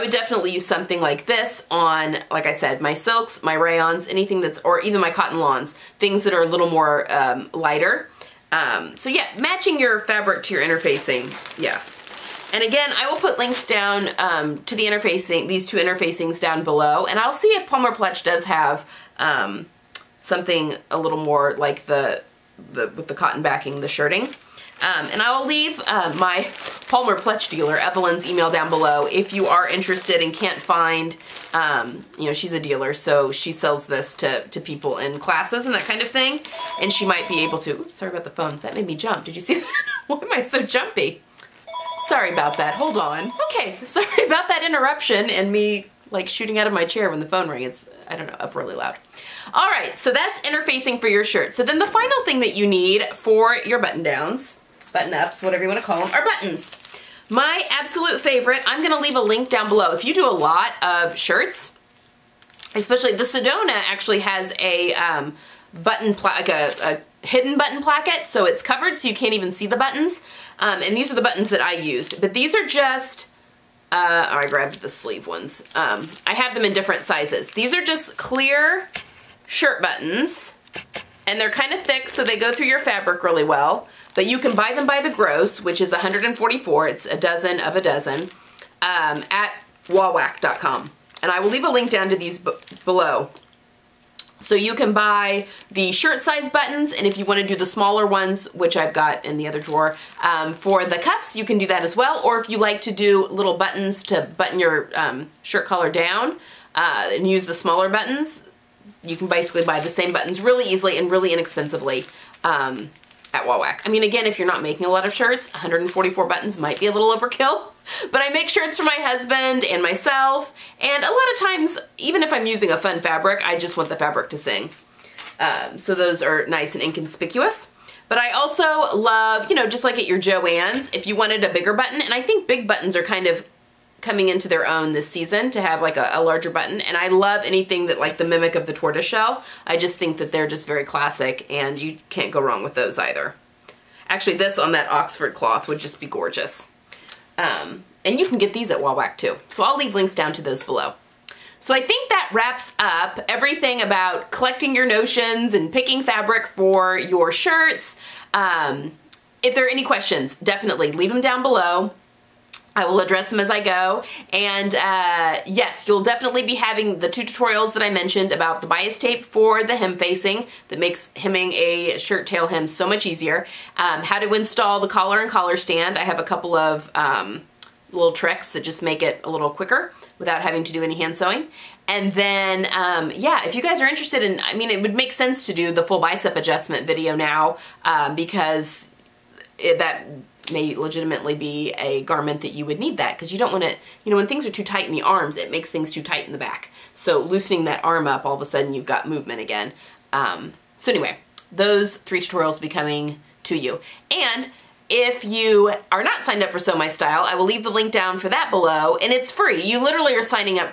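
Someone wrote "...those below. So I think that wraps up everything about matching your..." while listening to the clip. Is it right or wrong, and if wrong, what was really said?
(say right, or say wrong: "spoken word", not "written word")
wrong: "collecting", not "matching".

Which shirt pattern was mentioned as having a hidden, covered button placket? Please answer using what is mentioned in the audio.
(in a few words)
Sedona.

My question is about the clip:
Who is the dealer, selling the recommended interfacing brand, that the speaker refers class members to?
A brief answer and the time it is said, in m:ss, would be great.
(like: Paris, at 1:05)
Evelyn, at 0:27.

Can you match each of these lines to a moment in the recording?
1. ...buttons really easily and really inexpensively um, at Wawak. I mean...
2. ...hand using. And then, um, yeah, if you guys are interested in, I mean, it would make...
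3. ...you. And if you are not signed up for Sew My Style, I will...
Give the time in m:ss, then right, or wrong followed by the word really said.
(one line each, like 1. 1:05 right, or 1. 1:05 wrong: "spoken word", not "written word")
1. 1:50 right
2. 3:00 wrong: "sewing", not "using"
3. 3:23 right.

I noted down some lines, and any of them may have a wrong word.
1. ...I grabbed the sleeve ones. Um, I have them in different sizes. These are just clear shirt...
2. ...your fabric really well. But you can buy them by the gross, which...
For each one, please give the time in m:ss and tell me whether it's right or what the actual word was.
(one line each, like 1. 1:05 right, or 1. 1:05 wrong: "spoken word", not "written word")
1. 1:14 right
2. 1:22 right.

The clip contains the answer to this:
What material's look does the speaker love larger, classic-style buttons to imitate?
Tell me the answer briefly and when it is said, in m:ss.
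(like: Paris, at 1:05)
tortoiseshell, at 2:18.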